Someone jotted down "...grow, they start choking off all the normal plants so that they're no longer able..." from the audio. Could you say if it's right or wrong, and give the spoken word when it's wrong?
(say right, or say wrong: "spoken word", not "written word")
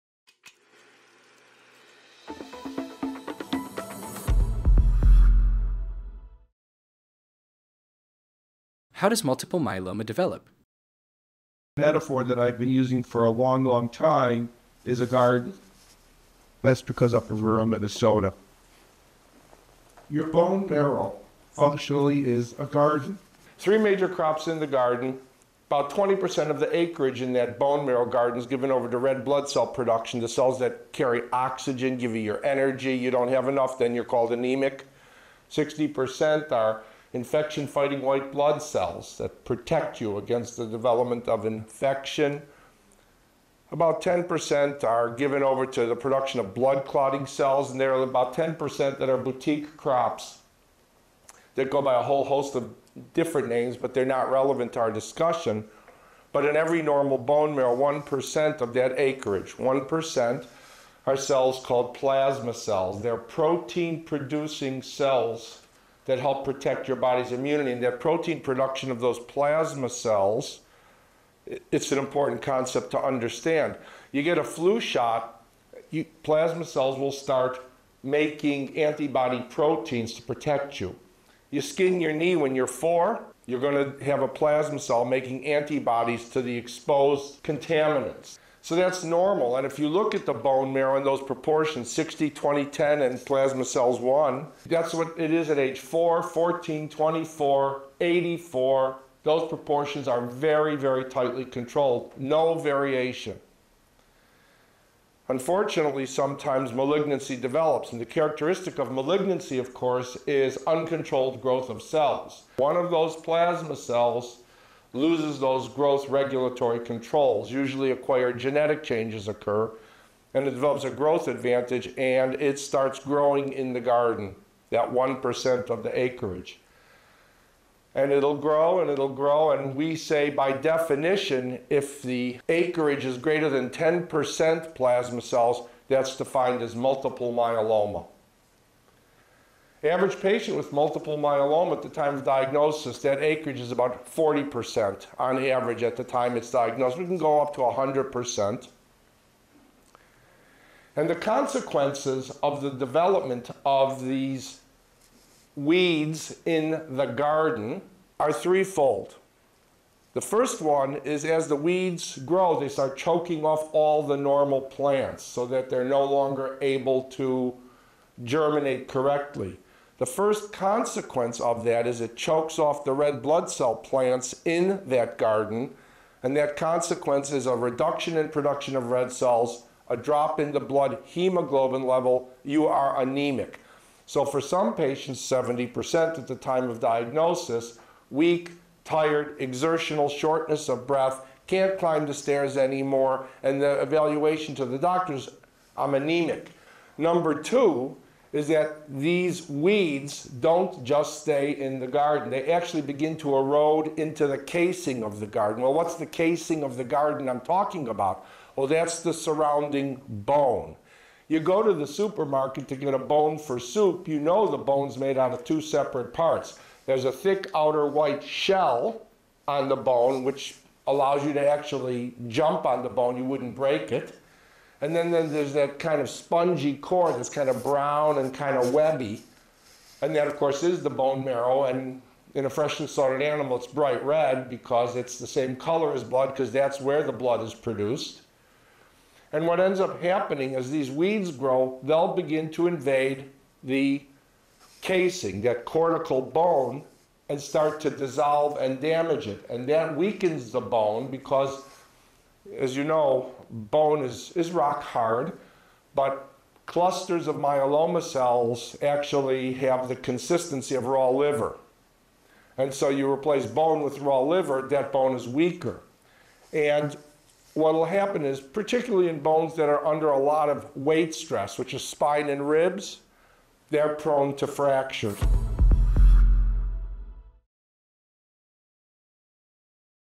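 right.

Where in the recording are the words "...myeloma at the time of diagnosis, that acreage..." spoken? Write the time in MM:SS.
02:21.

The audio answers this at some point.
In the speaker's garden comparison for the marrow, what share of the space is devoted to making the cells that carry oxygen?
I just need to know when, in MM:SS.
00:25.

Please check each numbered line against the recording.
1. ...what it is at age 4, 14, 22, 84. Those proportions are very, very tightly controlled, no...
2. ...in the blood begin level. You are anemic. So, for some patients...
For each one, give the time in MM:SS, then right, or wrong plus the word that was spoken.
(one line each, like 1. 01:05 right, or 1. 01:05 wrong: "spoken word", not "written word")
1. 01:34 wrong: "24", not "22"
2. 03:00 wrong: "hemoglobin", not "begin".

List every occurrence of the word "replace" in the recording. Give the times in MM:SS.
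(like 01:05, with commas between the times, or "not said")
04:23.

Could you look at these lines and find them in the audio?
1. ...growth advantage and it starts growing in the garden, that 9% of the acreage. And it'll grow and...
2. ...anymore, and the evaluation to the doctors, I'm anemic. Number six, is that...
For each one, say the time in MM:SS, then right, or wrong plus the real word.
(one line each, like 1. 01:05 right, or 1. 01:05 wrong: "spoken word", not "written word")
1. 02:00 wrong: "1", not "9"
2. 03:12 wrong: "two", not "six".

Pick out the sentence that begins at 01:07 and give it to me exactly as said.
And that protein production of those plasma cells, it's an important concept to understand.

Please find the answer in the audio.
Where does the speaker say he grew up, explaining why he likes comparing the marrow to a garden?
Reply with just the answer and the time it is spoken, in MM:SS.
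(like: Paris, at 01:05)
rural Minnesota, at 00:17.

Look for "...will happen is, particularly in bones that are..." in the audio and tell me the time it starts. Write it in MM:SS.
04:27.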